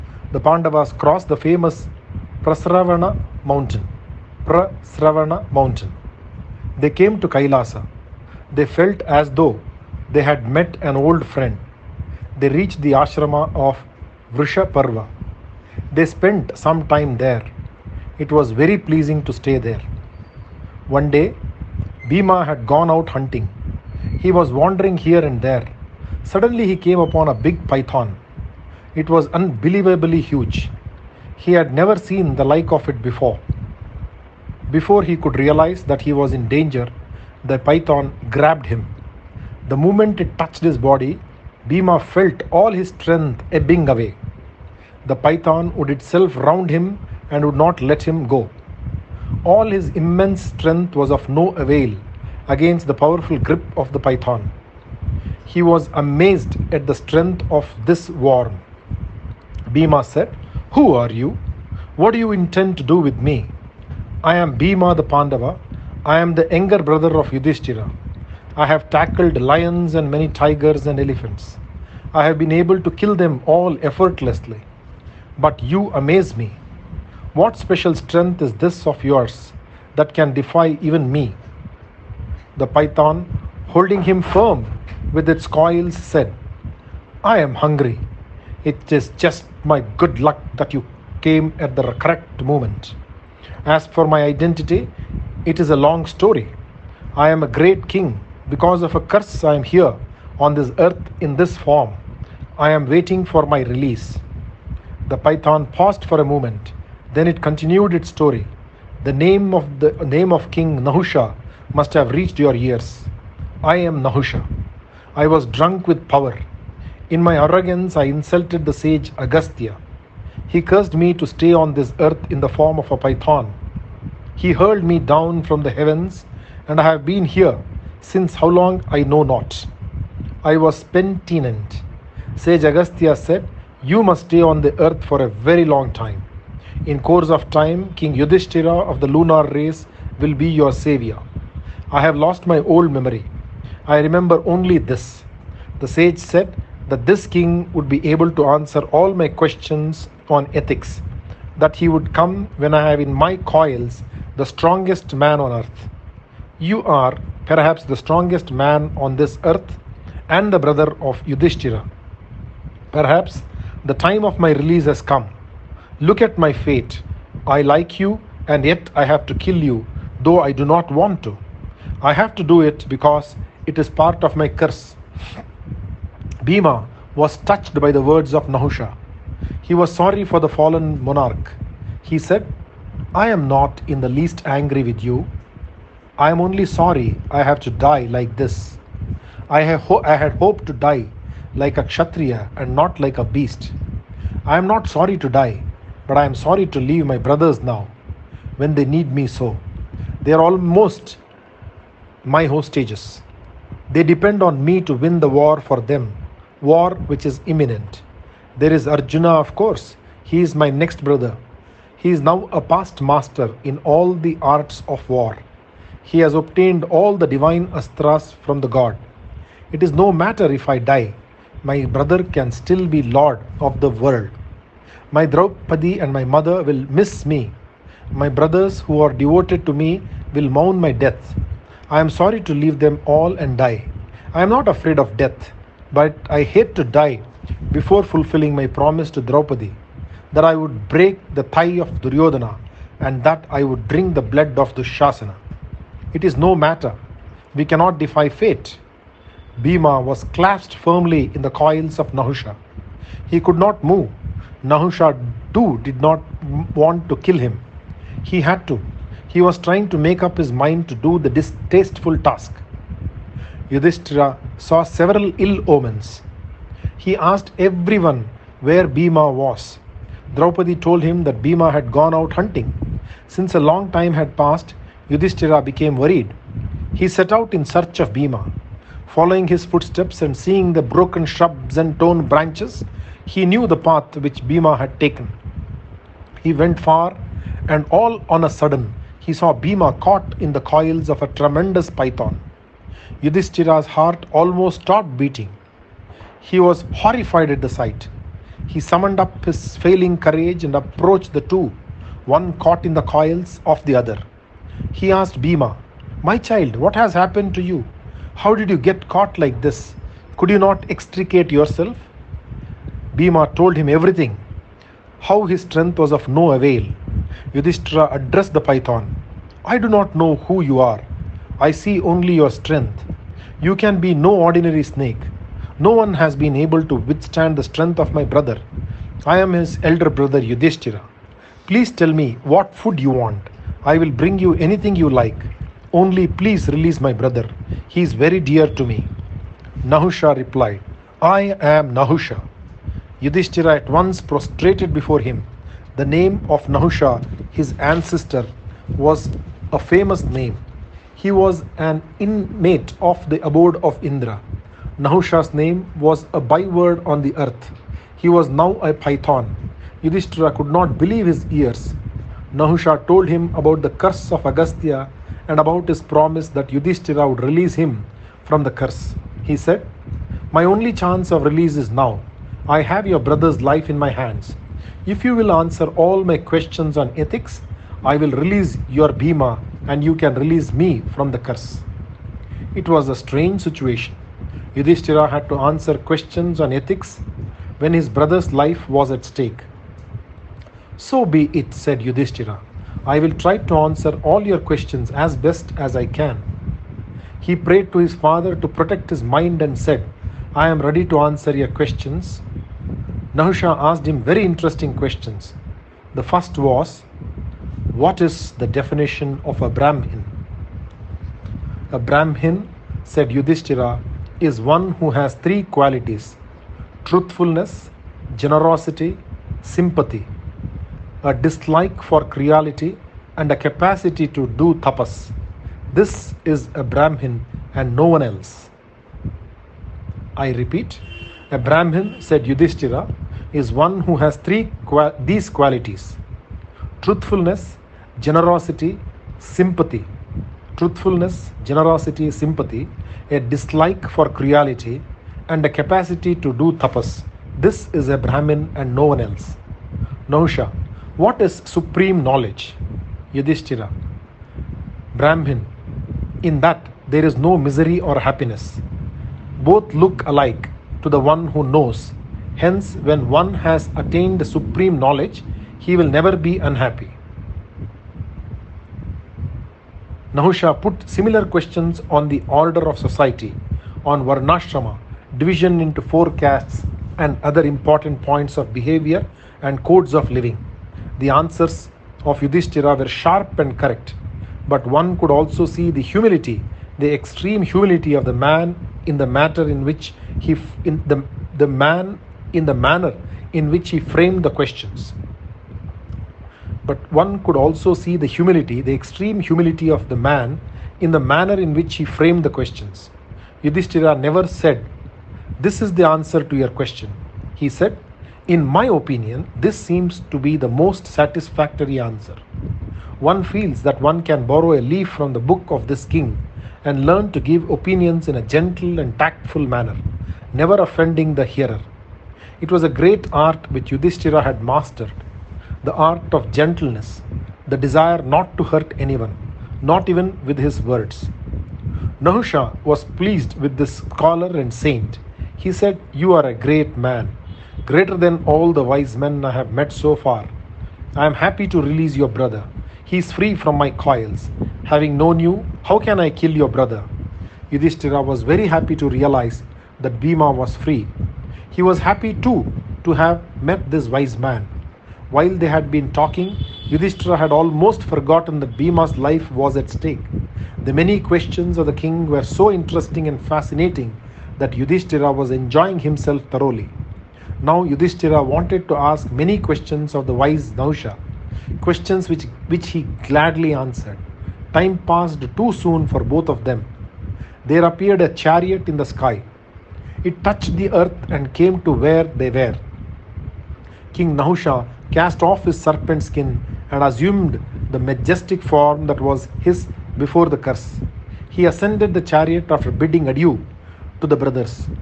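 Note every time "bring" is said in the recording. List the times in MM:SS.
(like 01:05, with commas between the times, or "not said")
05:34.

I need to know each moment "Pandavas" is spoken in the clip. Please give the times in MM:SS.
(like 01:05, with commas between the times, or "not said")
00:00, 01:05.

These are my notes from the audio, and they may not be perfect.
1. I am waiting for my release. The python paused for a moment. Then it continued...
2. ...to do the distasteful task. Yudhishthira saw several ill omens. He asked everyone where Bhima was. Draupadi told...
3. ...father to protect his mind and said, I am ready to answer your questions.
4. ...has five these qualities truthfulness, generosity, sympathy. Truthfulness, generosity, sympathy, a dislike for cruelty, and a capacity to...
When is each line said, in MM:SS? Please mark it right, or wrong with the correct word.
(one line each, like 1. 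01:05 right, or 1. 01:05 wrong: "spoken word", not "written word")
1. 01:42 right
2. 04:20 right
3. 06:38 right
4. 07:14 wrong: "three", not "five".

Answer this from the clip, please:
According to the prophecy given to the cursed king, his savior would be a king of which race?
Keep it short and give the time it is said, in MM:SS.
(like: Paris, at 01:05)
The lunar race, at 02:19.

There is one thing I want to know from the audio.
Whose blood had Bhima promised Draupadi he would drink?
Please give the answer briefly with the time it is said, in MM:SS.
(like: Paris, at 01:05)
Dushasana, at 04:04.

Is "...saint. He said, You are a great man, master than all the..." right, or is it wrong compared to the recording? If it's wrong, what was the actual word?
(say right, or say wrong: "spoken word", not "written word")
wrong: "greater", not "master".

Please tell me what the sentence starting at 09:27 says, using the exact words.
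Now Yudhishthira wanted to ask many questions of the wise Nahusha, questions which, which he gladly answered.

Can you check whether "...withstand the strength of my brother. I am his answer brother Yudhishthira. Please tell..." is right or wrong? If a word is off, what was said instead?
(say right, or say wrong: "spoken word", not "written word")
wrong: "elder", not "answer".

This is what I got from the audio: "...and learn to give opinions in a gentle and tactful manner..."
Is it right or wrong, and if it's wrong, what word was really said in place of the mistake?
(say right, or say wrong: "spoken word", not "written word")
right.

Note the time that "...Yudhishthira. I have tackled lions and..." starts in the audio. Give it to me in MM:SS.
01:07.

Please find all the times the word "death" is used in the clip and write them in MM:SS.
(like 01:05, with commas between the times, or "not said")
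03:50, 03:55.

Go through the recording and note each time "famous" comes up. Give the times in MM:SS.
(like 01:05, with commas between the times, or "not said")
00:01, 05:49.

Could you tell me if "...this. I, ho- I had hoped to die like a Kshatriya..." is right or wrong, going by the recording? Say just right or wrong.
right.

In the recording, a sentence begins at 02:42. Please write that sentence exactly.
Perhaps the time of my release has come.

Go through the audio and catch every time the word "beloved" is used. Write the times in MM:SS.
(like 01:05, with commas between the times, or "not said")
not said.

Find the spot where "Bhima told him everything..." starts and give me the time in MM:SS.
05:13.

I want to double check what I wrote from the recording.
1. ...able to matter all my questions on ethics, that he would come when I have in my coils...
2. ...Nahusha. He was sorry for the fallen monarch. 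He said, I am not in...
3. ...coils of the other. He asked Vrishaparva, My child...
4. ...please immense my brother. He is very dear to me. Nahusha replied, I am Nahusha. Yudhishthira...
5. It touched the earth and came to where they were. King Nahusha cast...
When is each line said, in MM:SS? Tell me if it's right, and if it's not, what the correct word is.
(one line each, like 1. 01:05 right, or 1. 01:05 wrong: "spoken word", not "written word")
1. 02:28 wrong: "answer", not "matter"
2. 02:58 right
3. 05:03 wrong: "Bhima", not "Vrishaparva"
4. 05:36 wrong: "release", not "immense"
5. 09:40 right.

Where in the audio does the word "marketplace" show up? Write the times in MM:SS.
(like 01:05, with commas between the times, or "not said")
not said.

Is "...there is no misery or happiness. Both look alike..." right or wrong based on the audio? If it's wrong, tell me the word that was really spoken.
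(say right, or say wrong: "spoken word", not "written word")
right.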